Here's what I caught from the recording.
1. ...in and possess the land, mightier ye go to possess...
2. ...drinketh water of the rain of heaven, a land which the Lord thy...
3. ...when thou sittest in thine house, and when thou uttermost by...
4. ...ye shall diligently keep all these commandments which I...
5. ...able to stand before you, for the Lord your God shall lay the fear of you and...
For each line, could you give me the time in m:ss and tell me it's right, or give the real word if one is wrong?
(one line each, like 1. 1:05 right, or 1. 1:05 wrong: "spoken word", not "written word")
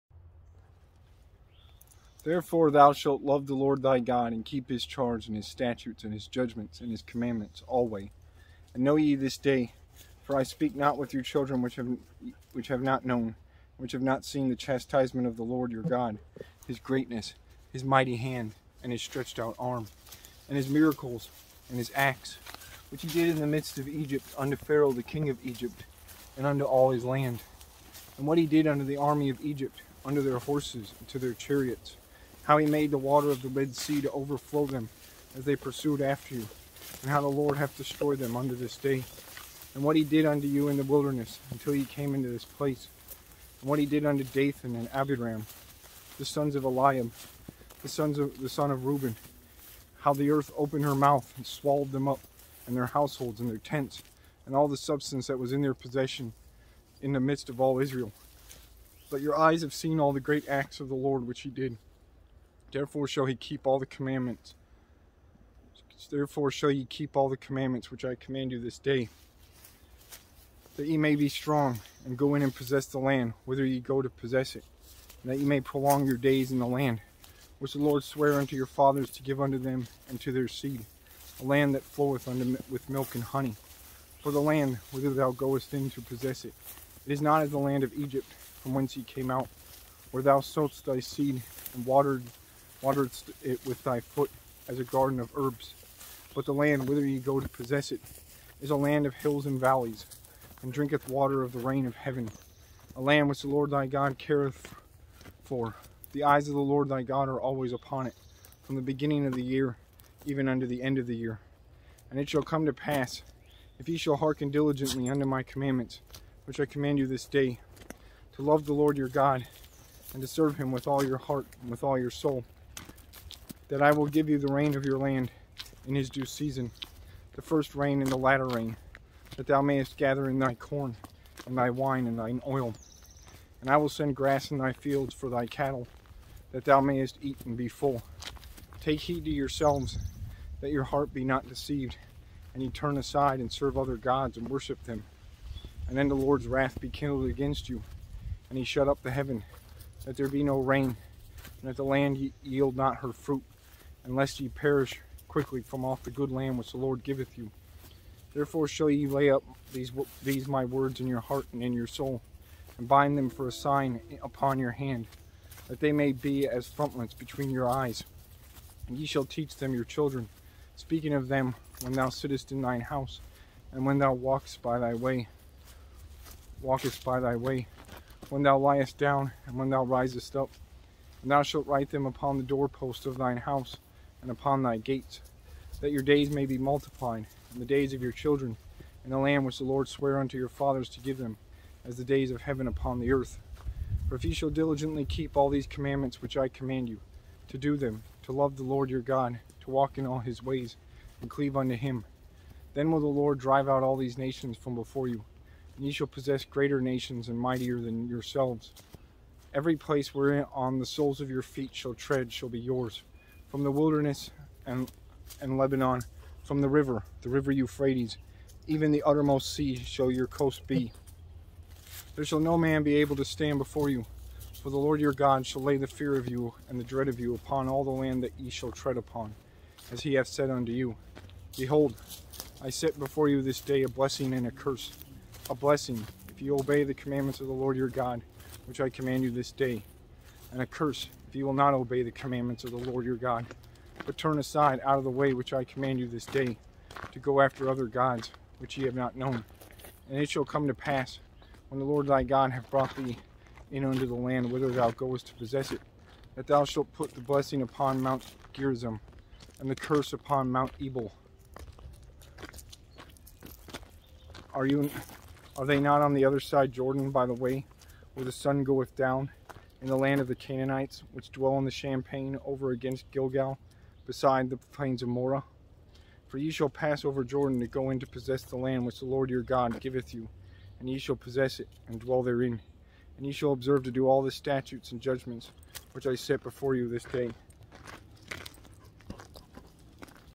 1. 1:12 wrong: "whither", not "mightier"
2. 1:40 right
3. 2:51 wrong: "walkest", not "uttermost"
4. 3:14 right
5. 3:42 right.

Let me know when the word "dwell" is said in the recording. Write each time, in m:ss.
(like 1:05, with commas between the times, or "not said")
4:31, 4:41.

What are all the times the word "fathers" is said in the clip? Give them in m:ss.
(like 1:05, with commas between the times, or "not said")
1:18, 3:10.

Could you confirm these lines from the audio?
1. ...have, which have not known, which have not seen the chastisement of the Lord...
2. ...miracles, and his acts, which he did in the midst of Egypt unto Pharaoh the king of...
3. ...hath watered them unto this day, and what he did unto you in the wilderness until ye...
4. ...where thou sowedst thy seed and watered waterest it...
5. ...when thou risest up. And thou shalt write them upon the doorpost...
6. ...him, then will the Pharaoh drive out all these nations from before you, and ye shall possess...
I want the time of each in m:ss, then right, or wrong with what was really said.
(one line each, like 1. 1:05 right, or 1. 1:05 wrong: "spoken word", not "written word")
1. 0:11 right
2. 0:20 right
3. 0:37 wrong: "destroyed", not "watered"
4. 1:30 right
5. 2:59 right
6. 3:21 wrong: "Lord", not "Pharaoh".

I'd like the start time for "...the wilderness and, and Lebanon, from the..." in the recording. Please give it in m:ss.
3:33.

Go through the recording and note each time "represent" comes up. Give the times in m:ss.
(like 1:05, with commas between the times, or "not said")
not said.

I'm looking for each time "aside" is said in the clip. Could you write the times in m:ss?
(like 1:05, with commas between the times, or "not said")
2:22, 4:04.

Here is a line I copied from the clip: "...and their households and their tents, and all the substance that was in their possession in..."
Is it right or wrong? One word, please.
right.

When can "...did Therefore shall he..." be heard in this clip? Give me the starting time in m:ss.
1:01.